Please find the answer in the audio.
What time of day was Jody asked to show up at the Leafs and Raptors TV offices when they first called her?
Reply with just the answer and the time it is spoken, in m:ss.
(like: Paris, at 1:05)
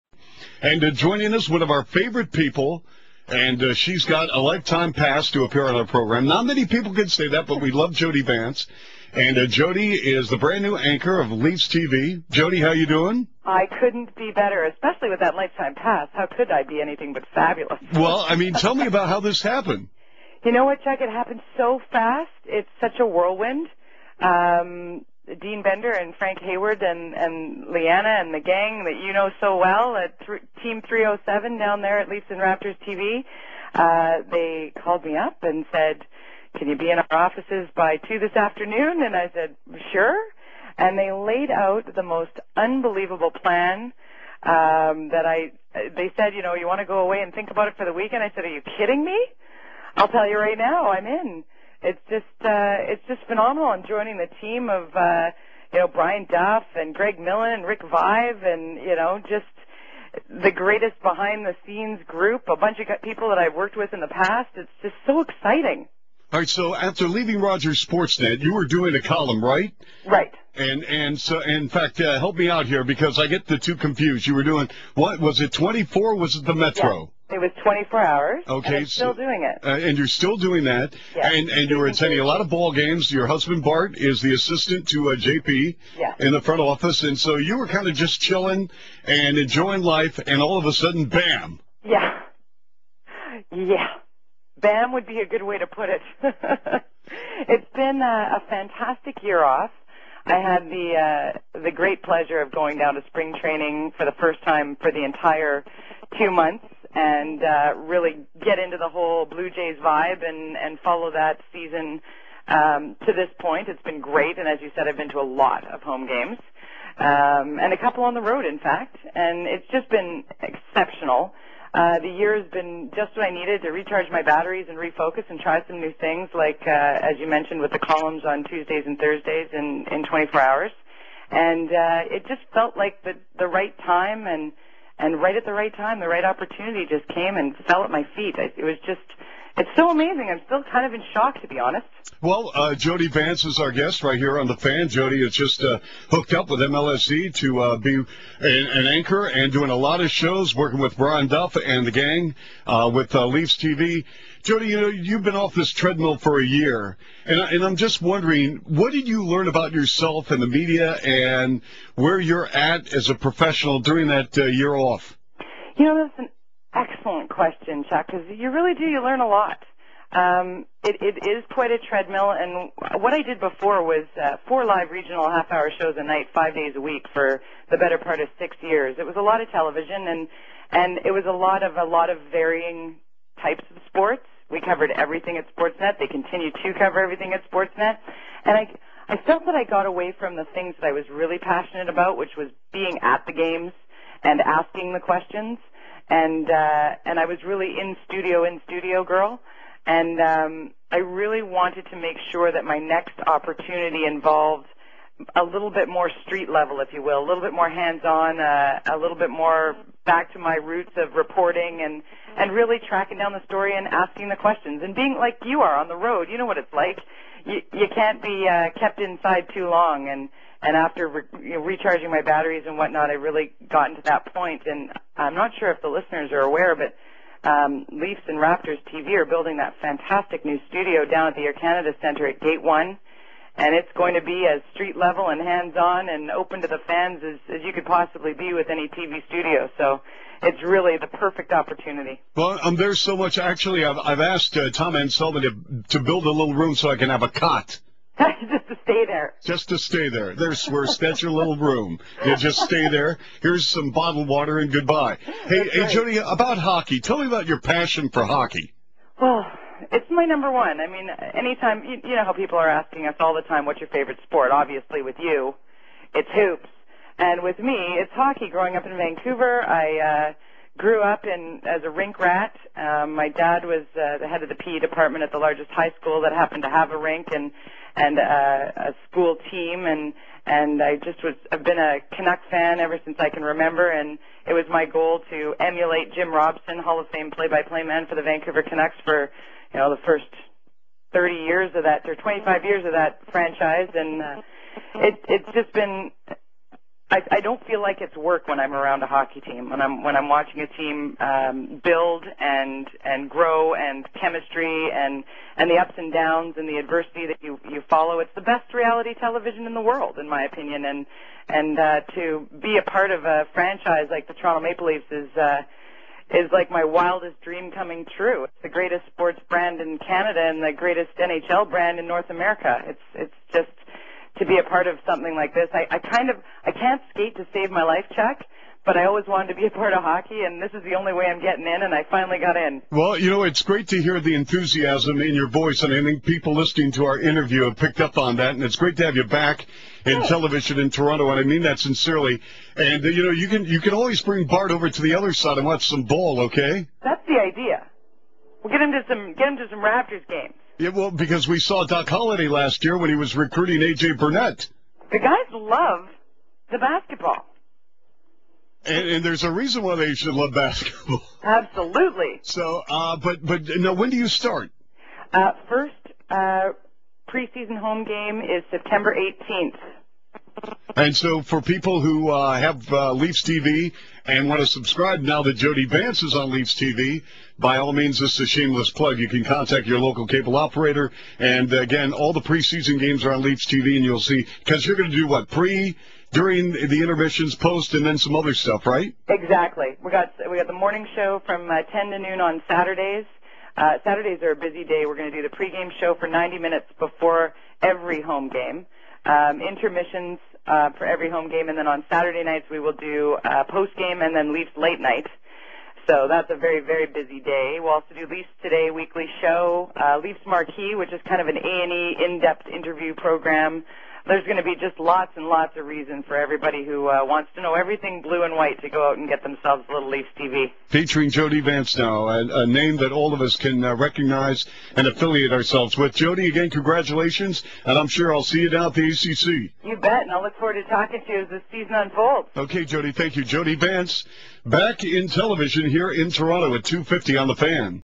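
2, at 0:37.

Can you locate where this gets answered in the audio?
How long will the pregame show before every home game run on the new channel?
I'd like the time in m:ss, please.
6:36.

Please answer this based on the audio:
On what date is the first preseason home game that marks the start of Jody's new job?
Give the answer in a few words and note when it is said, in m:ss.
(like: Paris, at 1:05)
September 18, at 6:08.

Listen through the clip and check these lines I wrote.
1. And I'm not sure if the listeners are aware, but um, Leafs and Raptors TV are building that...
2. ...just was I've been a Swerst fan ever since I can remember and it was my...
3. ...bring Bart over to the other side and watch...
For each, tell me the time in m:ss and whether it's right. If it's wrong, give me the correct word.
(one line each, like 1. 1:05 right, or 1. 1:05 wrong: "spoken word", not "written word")
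1. 3:44 right
2. 4:41 wrong: "Canuck", not "Swerst"
3. 5:44 right.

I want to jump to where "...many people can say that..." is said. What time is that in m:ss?
0:06.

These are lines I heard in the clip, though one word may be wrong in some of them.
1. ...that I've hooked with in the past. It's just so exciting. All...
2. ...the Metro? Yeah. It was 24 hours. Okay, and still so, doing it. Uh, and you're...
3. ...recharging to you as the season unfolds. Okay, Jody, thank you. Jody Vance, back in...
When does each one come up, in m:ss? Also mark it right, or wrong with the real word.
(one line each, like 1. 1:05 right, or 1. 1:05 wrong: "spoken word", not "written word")
1. 1:03 wrong: "worked", not "hooked"
2. 1:16 right
3. 7:10 wrong: "talking", not "recharging".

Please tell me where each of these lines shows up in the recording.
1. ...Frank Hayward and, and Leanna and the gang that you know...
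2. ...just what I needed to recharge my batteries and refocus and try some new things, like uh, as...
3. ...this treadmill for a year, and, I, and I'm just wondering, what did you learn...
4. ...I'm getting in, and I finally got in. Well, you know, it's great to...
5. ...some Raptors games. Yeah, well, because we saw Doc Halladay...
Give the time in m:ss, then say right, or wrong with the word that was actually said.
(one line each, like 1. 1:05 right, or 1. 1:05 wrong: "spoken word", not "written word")
1. 0:26 right
2. 2:02 right
3. 2:35 right
4. 5:31 right
5. 5:49 right.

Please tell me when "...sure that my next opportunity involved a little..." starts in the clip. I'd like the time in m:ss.
3:22.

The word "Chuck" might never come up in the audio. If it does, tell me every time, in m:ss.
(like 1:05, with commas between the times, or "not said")
0:20, 2:47, 5:28.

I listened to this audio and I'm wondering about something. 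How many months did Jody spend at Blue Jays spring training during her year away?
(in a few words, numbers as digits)
2.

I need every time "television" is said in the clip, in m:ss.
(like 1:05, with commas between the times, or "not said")
2:59, 5:09, 5:40, 7:15.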